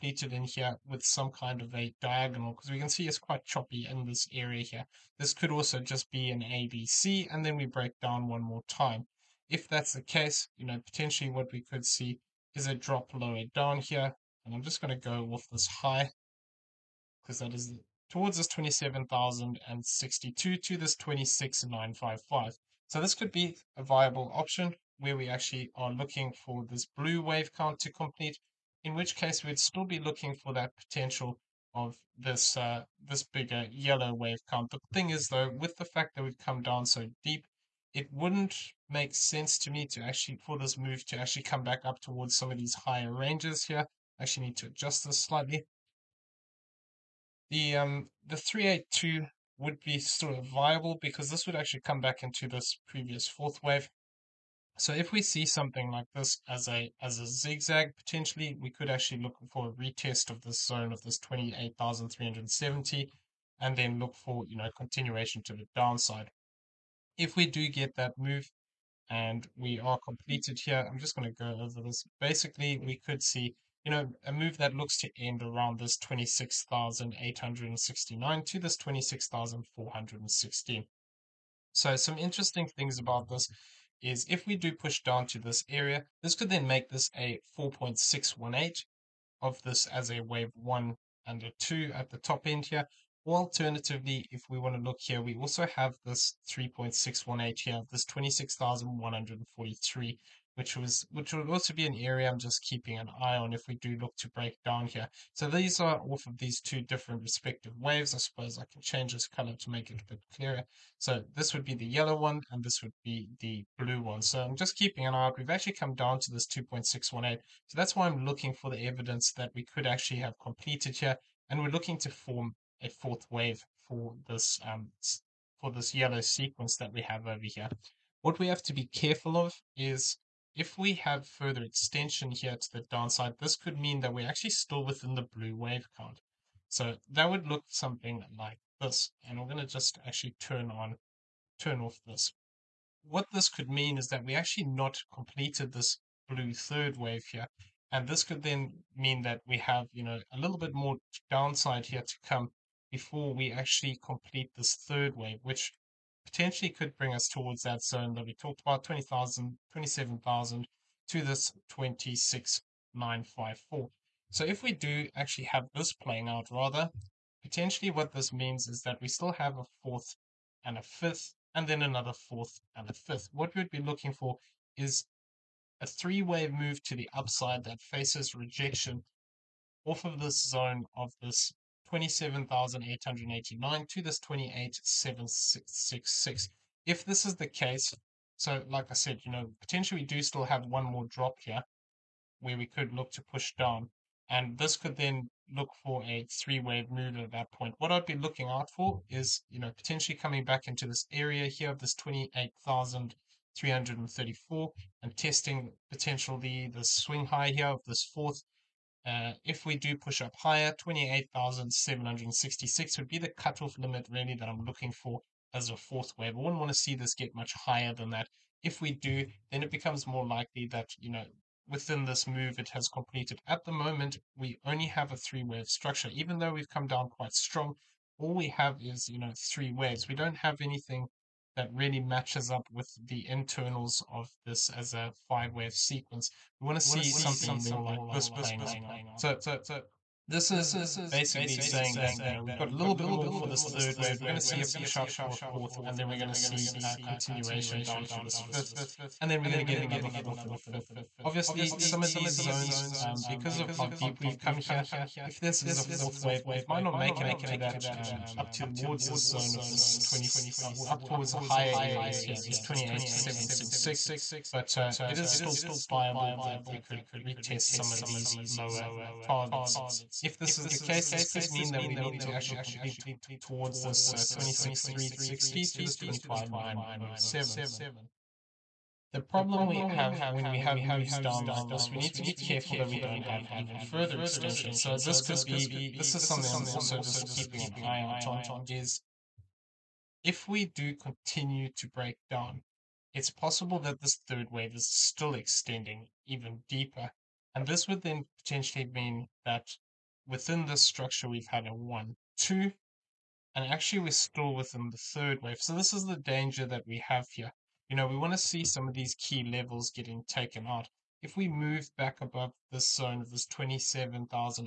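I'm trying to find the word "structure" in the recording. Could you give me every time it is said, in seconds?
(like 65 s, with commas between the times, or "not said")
225 s, 300 s.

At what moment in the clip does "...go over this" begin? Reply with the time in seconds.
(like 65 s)
71 s.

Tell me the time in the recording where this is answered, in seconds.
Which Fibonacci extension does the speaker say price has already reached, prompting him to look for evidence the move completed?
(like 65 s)
116 s.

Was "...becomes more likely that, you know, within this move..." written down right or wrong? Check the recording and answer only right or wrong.
right.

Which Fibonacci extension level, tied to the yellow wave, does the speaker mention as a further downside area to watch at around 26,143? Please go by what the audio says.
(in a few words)
3.618.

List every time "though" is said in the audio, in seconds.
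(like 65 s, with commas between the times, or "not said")
35 s, 226 s.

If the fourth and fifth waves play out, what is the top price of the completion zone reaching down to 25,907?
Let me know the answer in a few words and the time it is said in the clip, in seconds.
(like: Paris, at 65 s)
26,360, at 274 s.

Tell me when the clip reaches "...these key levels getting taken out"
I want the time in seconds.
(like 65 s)
308 s.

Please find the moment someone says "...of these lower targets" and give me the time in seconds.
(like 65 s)
267 s.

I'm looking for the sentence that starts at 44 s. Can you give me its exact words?
I actually need to adjust this slightly.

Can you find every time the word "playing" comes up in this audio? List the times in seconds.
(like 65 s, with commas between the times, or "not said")
165 s, 238 s.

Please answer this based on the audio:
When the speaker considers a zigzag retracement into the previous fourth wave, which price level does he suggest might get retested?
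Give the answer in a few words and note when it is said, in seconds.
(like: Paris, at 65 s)
28,370, at 61 s.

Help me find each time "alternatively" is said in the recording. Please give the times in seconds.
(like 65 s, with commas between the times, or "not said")
93 s.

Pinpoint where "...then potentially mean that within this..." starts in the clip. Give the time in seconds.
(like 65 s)
298 s.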